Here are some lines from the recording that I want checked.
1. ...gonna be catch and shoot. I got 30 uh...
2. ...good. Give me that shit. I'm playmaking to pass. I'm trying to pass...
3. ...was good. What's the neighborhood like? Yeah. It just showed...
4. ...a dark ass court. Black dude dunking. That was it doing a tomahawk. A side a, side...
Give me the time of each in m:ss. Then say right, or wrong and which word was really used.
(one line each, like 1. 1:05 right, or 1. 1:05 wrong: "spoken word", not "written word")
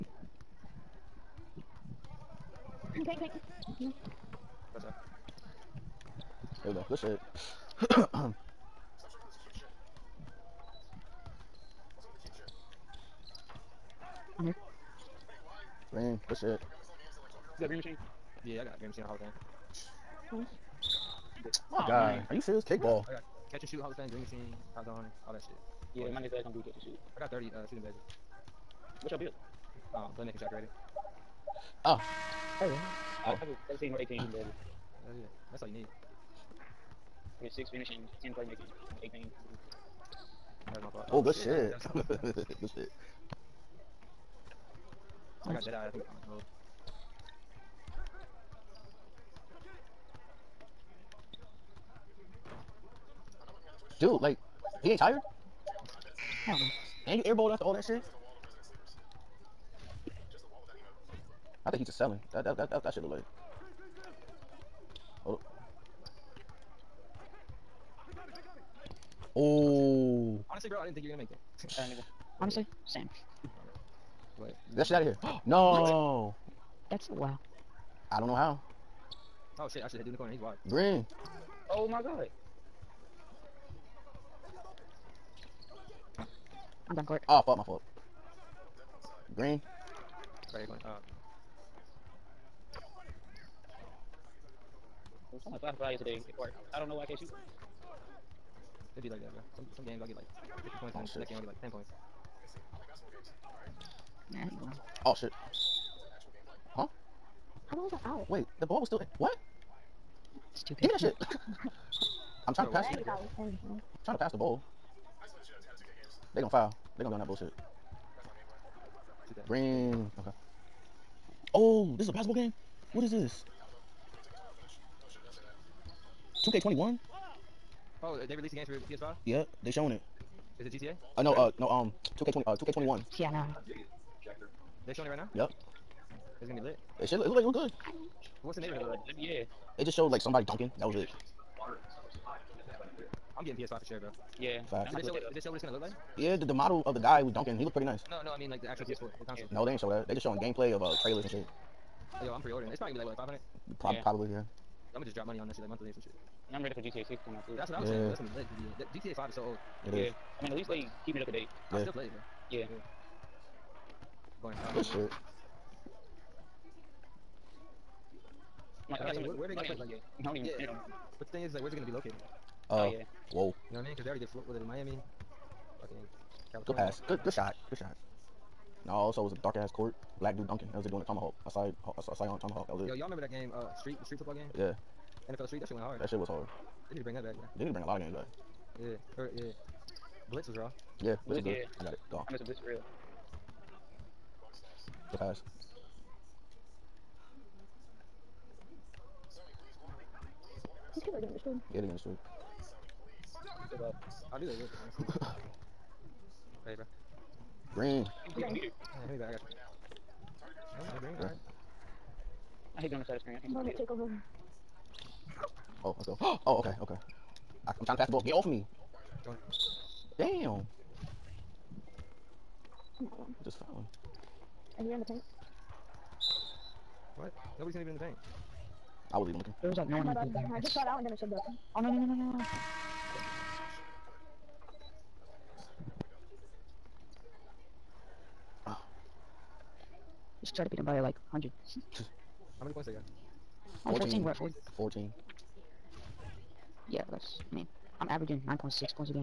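1. 0:26 right
2. 1:50 wrong: "trying", not "playmaking"
3. 2:17 right
4. 2:59 right.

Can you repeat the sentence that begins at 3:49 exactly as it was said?
There was like no one in the paint.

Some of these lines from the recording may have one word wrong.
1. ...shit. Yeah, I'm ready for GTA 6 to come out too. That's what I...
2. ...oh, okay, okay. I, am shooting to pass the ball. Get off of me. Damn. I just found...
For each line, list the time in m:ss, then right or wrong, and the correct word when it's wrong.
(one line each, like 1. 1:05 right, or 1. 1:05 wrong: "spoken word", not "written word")
1. 2:36 right
2. 3:36 wrong: "trying", not "shooting".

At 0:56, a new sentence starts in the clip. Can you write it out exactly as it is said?
I And you airballed after all that shit?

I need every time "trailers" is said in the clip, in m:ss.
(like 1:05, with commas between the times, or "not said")
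2:31.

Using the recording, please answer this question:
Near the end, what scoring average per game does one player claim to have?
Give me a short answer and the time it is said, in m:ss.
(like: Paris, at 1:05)
9.6, at 4:08.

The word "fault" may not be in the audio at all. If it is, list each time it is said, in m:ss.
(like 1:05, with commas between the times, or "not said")
0:40, 1:27.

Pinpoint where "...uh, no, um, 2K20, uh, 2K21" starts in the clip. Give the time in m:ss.
2:11.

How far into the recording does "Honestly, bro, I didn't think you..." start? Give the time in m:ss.
1:10.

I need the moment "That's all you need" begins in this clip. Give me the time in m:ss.
0:35.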